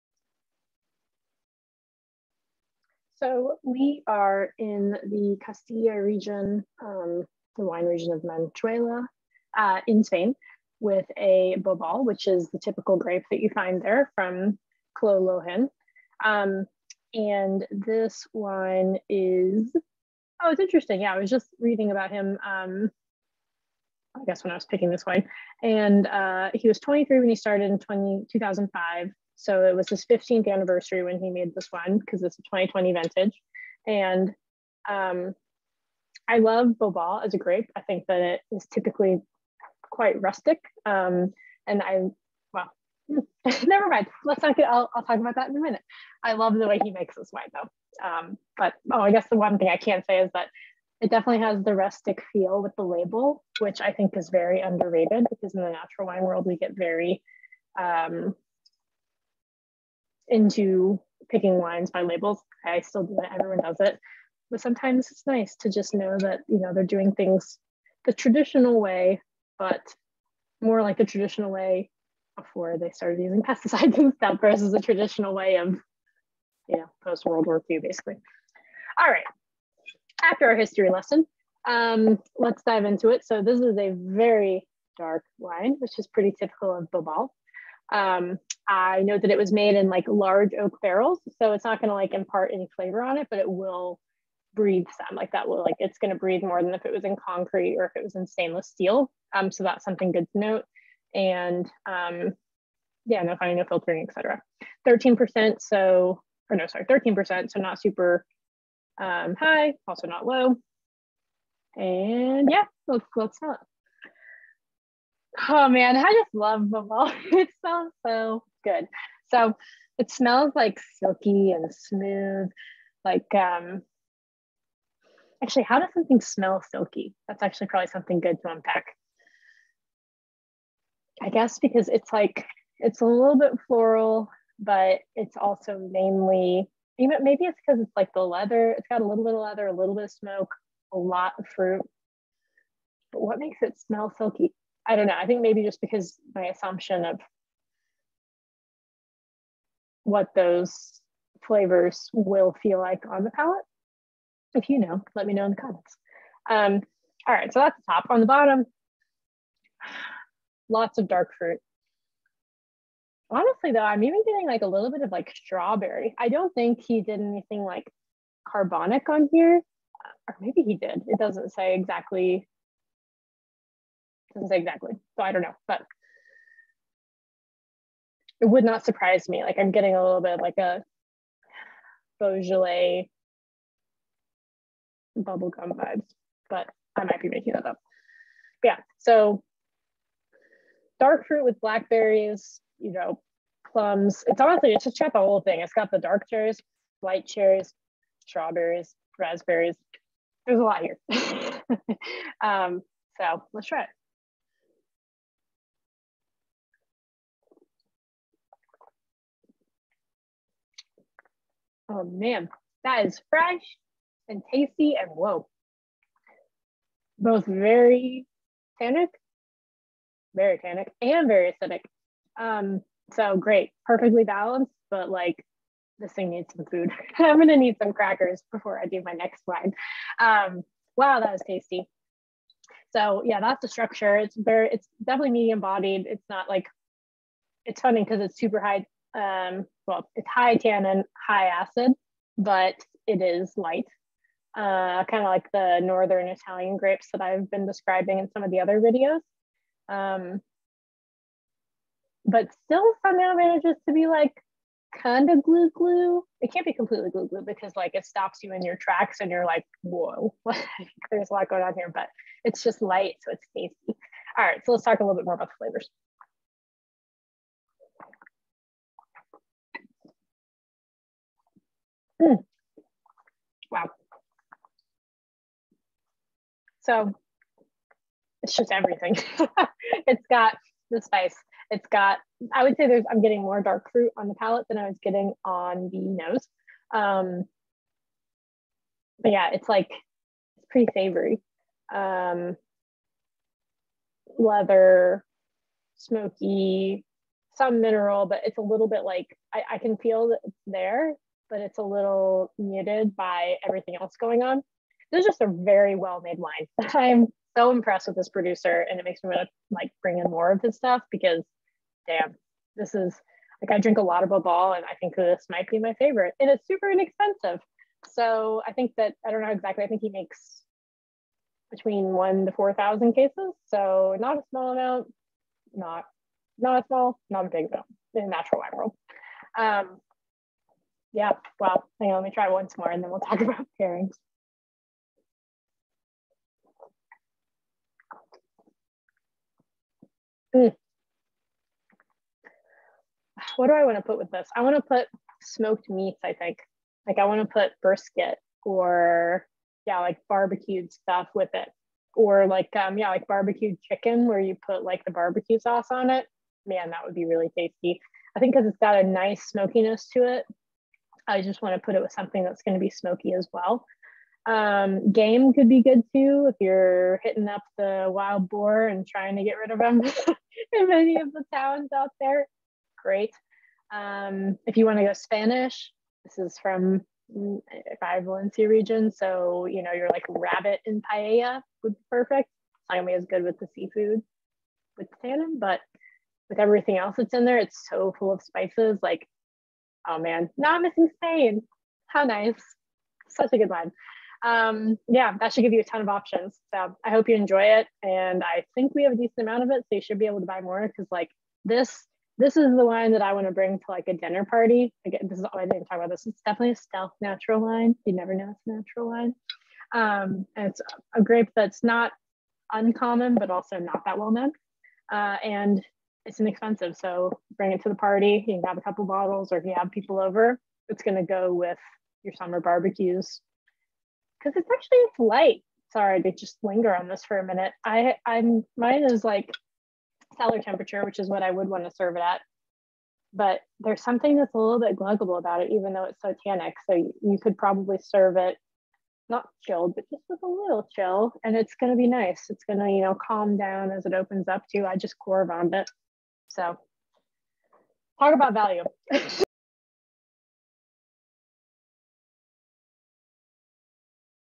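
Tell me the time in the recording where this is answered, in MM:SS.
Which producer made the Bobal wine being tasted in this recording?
00:14.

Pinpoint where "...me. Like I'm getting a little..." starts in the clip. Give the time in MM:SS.
02:59.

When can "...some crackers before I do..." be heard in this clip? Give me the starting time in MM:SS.
03:47.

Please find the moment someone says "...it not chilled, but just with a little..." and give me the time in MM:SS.
07:18.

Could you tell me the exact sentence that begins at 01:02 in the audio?
I still do it, everyone does it.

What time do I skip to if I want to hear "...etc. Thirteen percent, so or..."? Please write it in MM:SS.
01:44.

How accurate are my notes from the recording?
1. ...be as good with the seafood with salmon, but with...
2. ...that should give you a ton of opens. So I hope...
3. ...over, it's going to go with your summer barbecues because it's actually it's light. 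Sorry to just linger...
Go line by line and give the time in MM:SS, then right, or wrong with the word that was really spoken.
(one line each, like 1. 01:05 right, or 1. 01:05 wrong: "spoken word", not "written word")
1. 06:23 right
2. 06:35 wrong: "options", not "opens"
3. 07:00 right.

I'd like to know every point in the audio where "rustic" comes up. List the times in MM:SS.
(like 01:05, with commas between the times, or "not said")
00:40, 00:51.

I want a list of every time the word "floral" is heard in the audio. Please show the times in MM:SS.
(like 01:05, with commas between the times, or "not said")
02:13.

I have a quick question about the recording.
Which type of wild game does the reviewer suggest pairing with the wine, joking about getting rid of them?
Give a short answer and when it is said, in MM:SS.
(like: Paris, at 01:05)
Wild boar, at 06:08.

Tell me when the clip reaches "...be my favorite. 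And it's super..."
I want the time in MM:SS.
05:15.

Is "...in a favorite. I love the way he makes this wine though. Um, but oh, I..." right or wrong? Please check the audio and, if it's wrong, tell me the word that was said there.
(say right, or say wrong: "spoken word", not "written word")
wrong: "minute", not "favorite".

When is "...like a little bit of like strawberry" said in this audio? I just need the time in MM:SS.
02:44.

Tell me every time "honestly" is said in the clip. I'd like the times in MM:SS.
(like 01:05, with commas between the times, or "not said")
02:43, 03:14.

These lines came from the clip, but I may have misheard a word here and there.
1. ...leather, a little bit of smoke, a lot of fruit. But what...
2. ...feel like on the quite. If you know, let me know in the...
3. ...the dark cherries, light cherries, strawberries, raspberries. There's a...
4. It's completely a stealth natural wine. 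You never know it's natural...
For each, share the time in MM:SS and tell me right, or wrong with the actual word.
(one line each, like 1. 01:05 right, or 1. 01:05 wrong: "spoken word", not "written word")
1. 02:19 right
2. 02:32 wrong: "palate", not "quite"
3. 03:15 right
4. 06:46 wrong: "definitely", not "completely".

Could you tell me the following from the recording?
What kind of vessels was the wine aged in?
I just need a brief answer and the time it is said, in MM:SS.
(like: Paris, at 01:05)
Large oak barrels, at 01:30.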